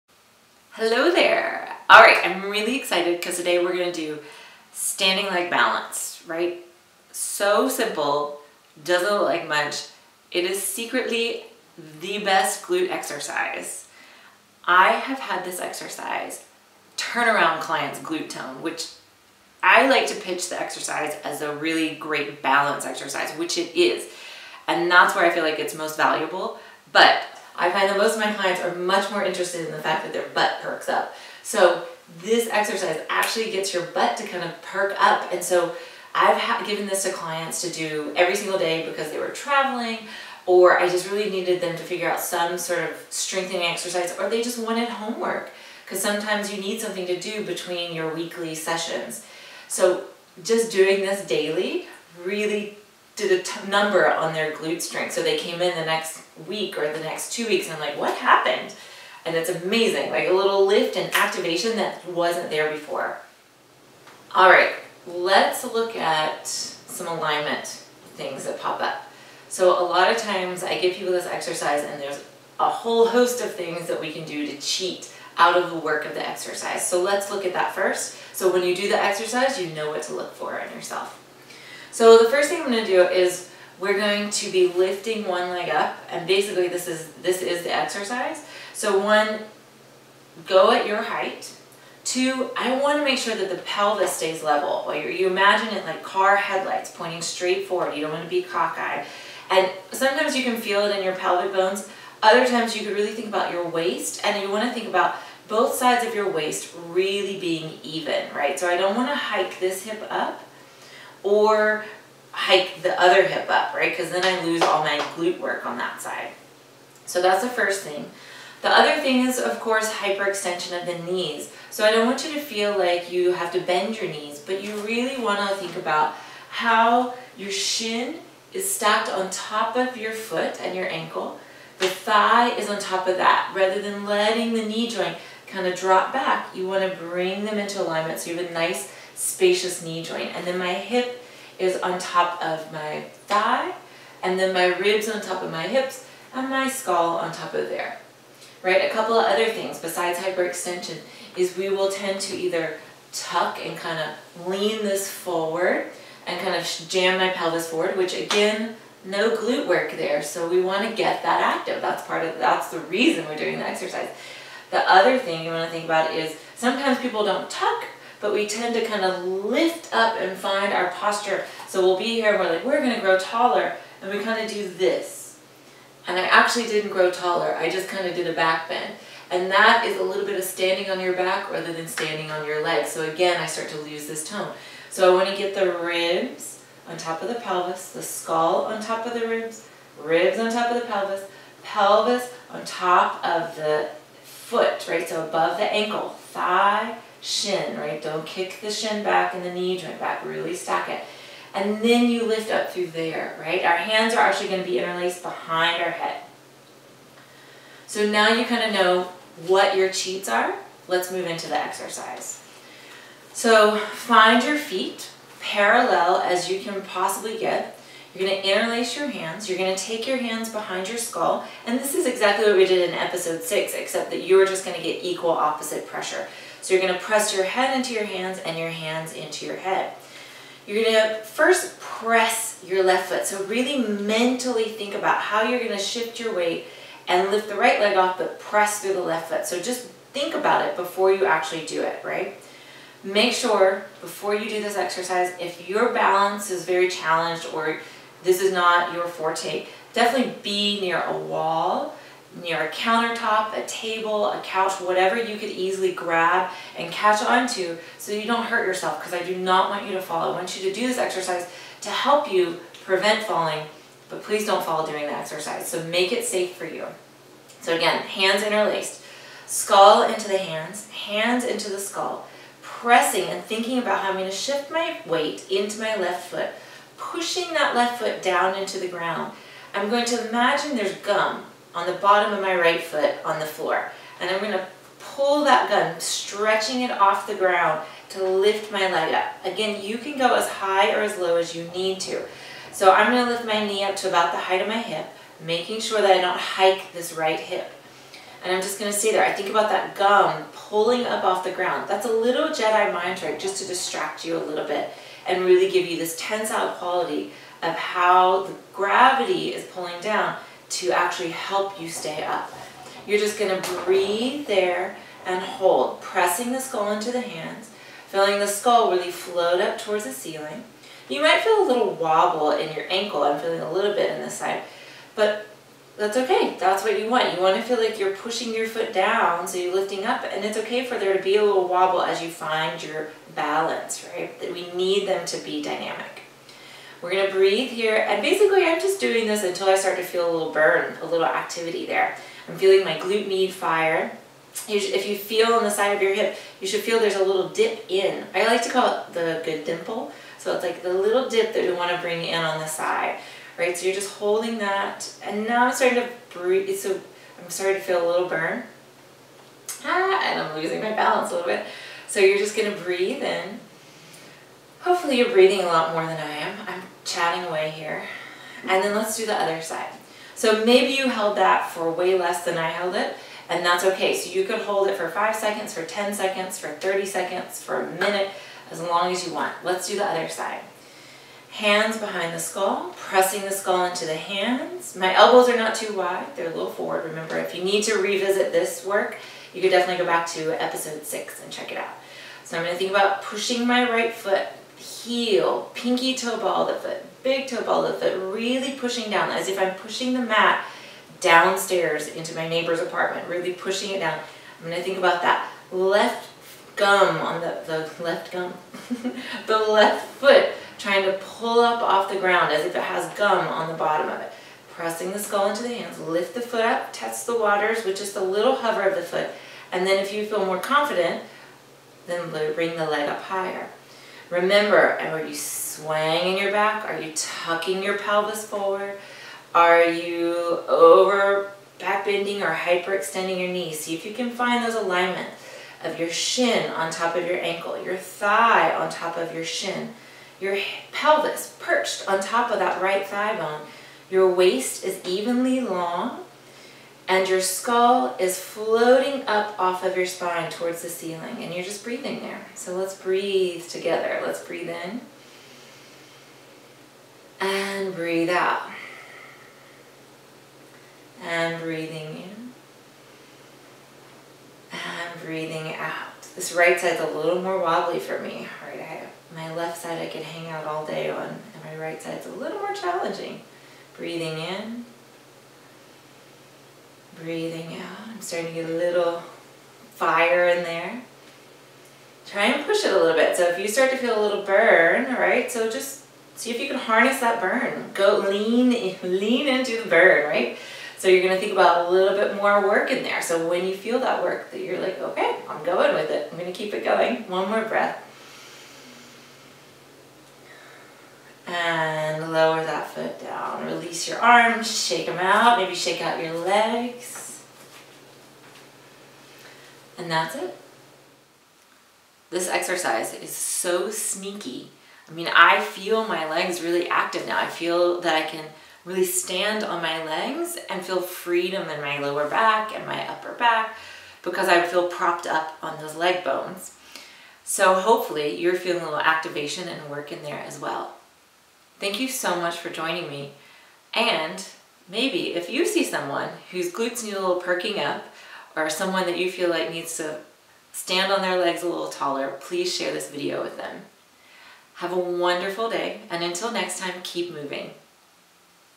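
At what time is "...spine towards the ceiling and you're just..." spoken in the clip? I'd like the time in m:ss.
7:30.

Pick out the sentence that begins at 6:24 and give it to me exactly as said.
My elbows are not too wide, they're a little forward.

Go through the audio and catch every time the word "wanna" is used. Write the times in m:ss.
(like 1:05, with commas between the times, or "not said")
3:05, 5:51.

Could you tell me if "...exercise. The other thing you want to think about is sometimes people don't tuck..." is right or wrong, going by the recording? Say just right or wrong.
right.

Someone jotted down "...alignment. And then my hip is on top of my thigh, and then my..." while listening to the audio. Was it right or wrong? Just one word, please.
wrong.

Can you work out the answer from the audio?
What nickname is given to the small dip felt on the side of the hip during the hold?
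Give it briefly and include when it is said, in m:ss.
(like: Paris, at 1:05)
the good dimple, at 5:49.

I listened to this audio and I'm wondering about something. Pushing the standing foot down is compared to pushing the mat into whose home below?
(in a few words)
my neighbor's apartment.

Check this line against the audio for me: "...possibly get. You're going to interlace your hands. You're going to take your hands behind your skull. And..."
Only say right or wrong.
right.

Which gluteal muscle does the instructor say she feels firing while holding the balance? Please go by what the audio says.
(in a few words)
glute med.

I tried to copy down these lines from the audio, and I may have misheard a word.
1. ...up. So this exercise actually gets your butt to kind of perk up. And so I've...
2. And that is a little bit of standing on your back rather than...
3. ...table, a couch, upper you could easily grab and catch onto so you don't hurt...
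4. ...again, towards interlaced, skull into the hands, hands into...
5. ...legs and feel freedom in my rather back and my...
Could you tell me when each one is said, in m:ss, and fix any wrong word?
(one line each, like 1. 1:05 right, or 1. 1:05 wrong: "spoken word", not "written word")
1. 0:30 right
2. 2:59 right
3. 4:13 wrong: "whatever", not "upper"
4. 4:27 wrong: "hands", not "towards"
5. 8:40 wrong: "lower", not "rather".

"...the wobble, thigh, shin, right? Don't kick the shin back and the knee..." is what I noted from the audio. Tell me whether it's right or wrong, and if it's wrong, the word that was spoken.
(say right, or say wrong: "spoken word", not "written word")
wrong: "ankle", not "wobble".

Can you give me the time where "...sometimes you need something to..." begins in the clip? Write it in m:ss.
0:46.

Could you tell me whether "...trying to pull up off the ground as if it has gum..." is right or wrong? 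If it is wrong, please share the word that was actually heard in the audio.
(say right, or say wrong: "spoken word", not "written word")
right.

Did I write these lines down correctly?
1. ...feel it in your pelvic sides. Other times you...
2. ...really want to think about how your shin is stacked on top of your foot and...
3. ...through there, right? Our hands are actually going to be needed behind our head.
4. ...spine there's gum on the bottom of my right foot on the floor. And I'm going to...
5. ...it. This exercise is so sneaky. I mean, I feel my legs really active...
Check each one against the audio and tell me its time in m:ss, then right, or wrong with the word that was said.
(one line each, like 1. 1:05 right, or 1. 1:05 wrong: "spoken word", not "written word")
1. 1:40 wrong: "bones", not "sides"
2. 2:04 right
3. 3:22 wrong: "interlaced", not "needed"
4. 4:40 wrong: "imagine", not "spine"
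5. 8:30 right.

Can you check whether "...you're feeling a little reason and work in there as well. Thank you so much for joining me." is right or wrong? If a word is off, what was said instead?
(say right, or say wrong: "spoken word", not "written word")
wrong: "activation", not "reason".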